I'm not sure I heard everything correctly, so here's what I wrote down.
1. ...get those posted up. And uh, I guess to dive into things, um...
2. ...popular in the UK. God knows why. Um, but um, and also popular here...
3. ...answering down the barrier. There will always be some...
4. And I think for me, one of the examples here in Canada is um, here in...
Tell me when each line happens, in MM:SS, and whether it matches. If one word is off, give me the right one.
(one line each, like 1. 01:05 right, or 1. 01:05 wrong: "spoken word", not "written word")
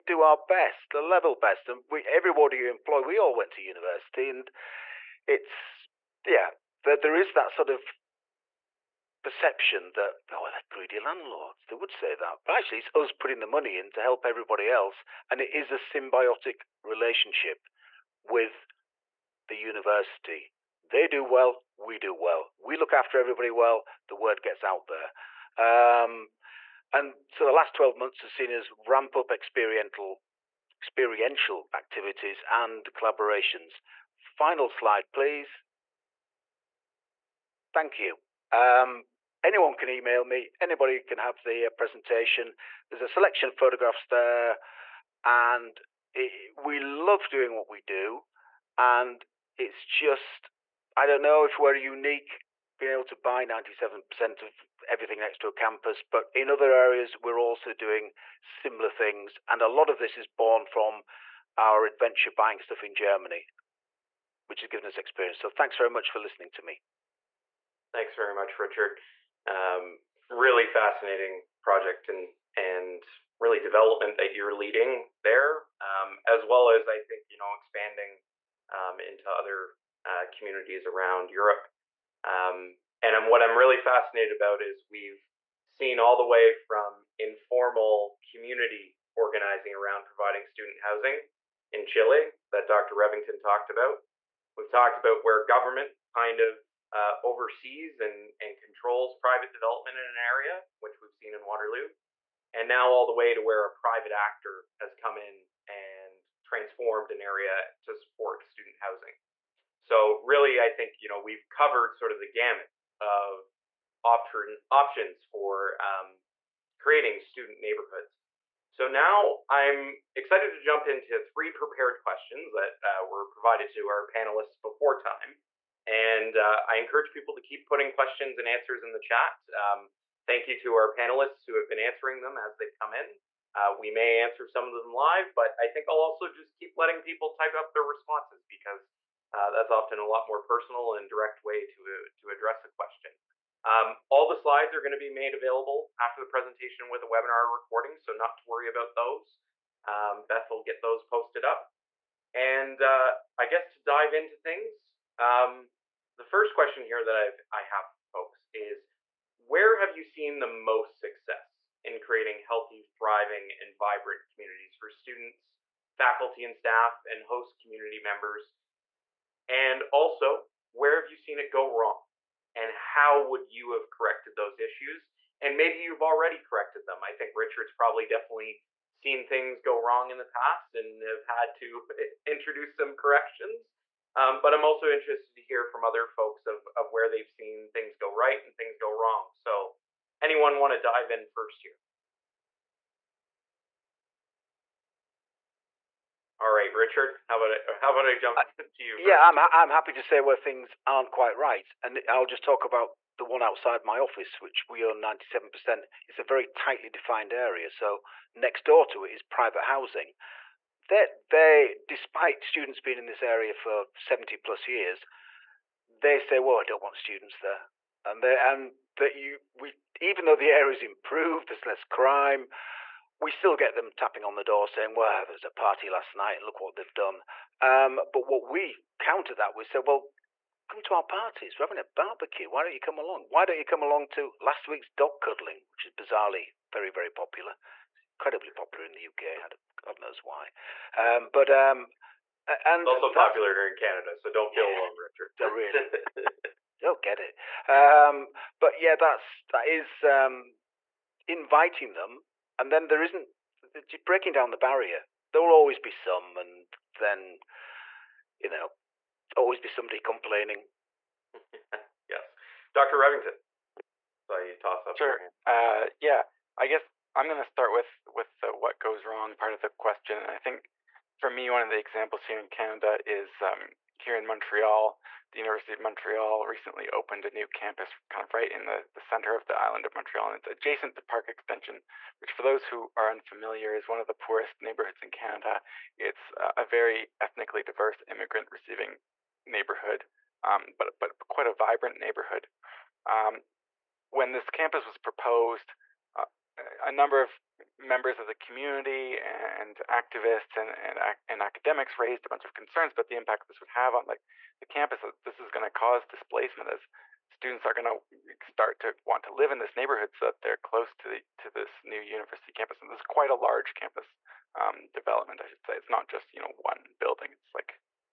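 1. 02:30 right
2. 03:58 right
3. 04:14 wrong: "breaking", not "answering"
4. 04:30 right.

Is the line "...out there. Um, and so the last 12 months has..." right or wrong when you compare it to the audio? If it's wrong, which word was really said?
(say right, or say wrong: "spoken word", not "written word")
right.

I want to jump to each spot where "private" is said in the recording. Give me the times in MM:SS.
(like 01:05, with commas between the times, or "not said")
01:39, 01:43, 03:29.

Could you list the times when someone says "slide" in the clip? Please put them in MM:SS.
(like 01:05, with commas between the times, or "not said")
00:34, 02:24.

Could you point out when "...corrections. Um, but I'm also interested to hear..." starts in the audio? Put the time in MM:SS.
03:02.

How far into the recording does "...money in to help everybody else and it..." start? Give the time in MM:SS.
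00:13.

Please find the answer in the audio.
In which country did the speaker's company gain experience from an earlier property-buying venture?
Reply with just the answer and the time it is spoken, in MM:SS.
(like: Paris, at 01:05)
Germany, at 01:02.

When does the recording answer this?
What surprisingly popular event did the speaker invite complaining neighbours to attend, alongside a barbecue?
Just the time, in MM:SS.
03:54.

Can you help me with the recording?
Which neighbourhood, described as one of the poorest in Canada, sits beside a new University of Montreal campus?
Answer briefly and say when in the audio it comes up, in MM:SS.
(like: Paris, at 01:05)
Park Extension, at 04:41.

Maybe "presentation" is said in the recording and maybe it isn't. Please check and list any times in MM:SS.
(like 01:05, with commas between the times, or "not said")
00:41, 02:26.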